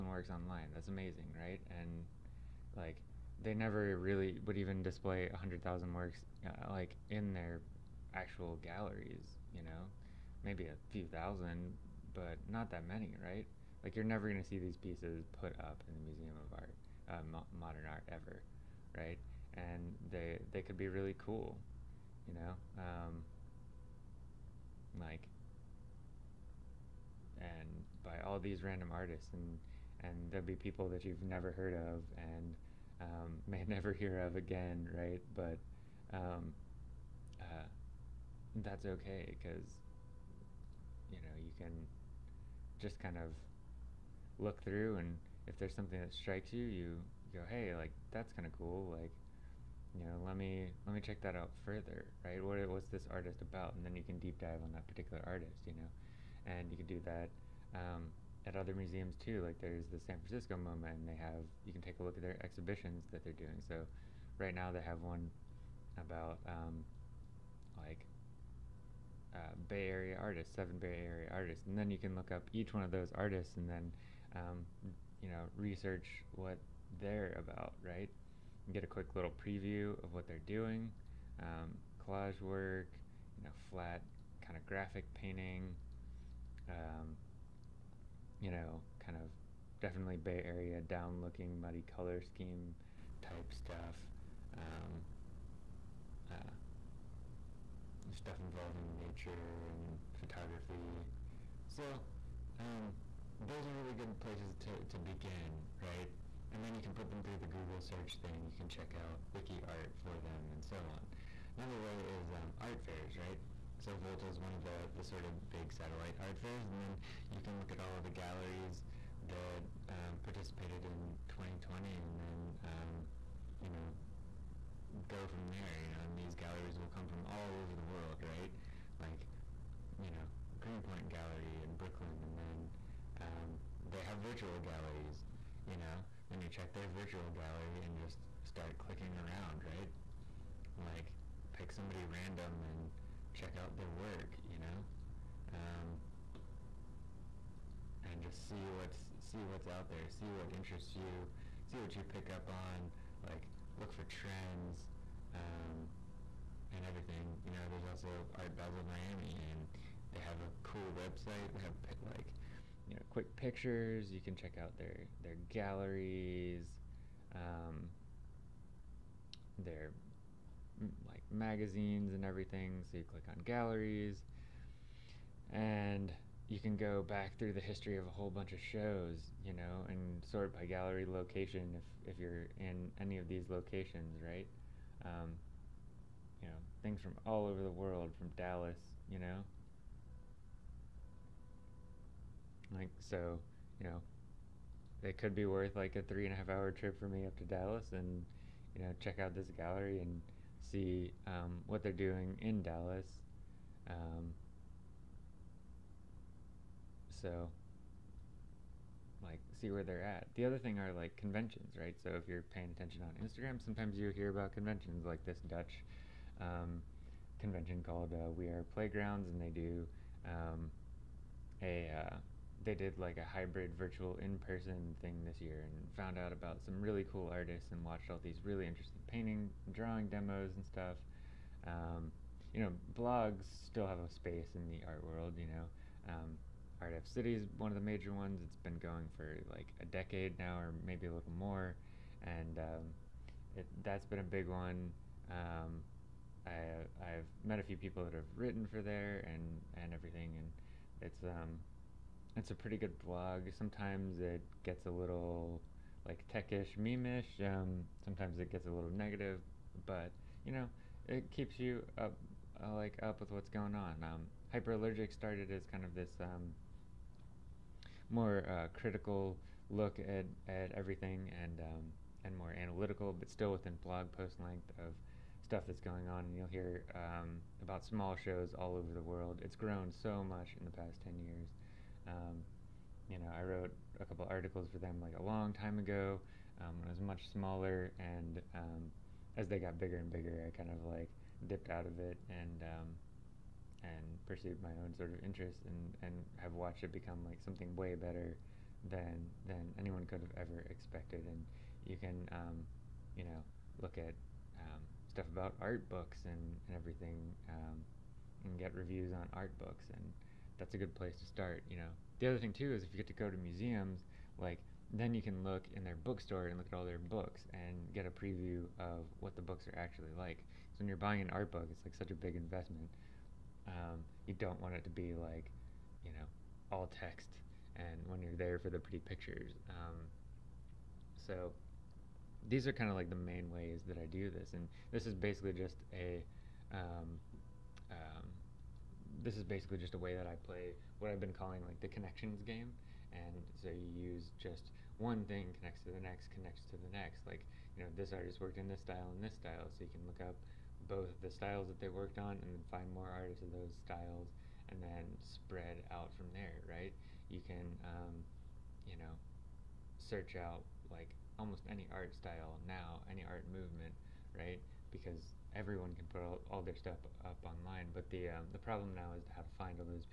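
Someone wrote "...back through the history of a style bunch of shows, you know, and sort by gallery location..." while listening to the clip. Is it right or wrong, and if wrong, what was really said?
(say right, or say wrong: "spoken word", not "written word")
wrong: "whole", not "style".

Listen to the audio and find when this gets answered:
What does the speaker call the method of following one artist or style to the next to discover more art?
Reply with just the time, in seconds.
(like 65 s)
341 s.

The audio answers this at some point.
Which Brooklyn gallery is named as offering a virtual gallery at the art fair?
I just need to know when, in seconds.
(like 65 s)
130 s.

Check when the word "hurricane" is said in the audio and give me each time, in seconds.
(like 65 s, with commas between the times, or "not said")
not said.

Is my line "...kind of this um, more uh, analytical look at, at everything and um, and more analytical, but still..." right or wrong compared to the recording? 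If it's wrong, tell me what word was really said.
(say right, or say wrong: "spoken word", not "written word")
wrong: "critical", not "analytical".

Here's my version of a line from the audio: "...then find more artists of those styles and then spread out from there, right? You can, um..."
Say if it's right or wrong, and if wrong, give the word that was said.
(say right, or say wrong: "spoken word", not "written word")
right.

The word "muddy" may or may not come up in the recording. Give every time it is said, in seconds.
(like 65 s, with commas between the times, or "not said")
91 s.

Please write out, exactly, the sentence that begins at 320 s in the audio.
So when you're buying an art book, it's like such a big investment.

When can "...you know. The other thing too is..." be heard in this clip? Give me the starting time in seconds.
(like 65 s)
311 s.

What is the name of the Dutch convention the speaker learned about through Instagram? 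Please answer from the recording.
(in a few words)
We Are Playgrounds.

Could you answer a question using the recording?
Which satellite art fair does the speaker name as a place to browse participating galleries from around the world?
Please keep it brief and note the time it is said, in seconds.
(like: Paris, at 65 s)
Volta, at 113 s.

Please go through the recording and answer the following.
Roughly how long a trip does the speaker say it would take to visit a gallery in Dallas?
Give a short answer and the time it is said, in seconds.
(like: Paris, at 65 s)
3 and a half hours, at 196 s.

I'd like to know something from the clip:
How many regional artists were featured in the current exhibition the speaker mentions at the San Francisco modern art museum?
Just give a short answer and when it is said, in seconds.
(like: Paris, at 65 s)
7, at 70 s.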